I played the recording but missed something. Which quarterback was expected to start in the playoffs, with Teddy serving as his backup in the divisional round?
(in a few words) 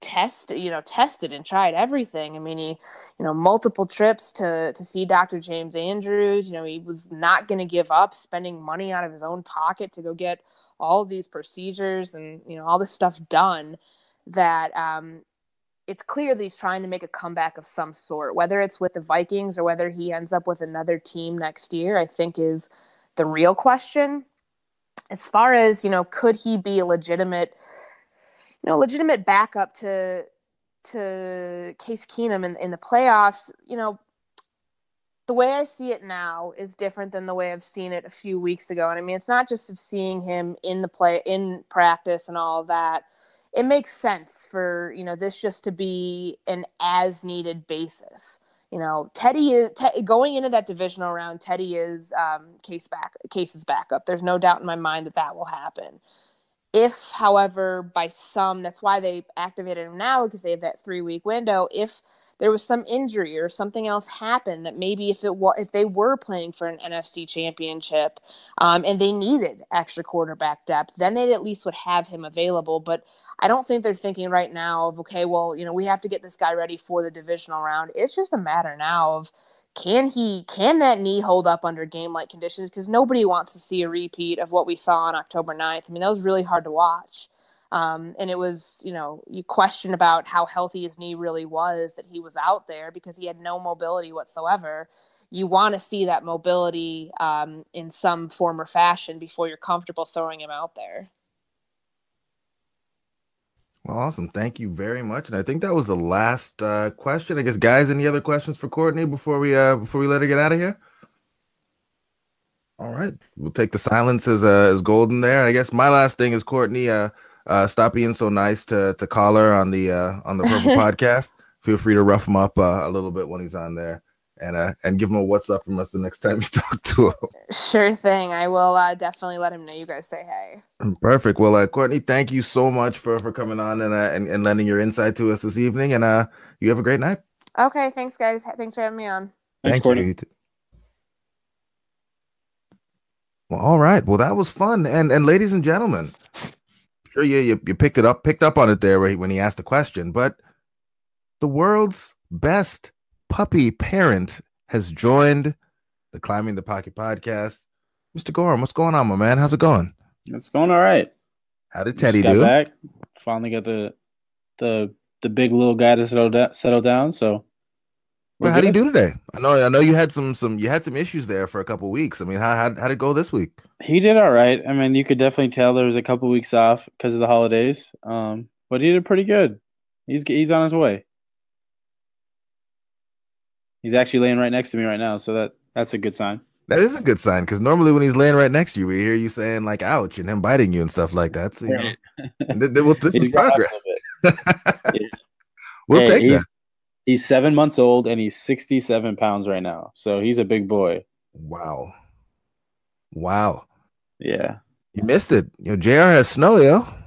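Case Keenum.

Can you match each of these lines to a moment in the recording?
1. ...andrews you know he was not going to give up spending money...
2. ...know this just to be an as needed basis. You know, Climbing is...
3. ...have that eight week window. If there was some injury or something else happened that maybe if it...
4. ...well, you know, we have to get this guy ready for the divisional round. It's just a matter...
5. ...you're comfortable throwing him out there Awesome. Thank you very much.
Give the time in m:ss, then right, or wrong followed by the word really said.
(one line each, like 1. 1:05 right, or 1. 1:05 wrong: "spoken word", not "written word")
1. 0:05 right
2. 0:45 wrong: "Teddy", not "Climbing"
3. 1:00 wrong: "three", not "eight"
4. 1:15 right
5. 1:39 right.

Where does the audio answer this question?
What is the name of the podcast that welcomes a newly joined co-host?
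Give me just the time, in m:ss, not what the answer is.
2:36.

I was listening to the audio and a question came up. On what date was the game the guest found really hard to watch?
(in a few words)
October 9.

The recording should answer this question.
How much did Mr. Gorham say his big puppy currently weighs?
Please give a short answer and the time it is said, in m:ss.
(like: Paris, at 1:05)
67 pounds, at 3:18.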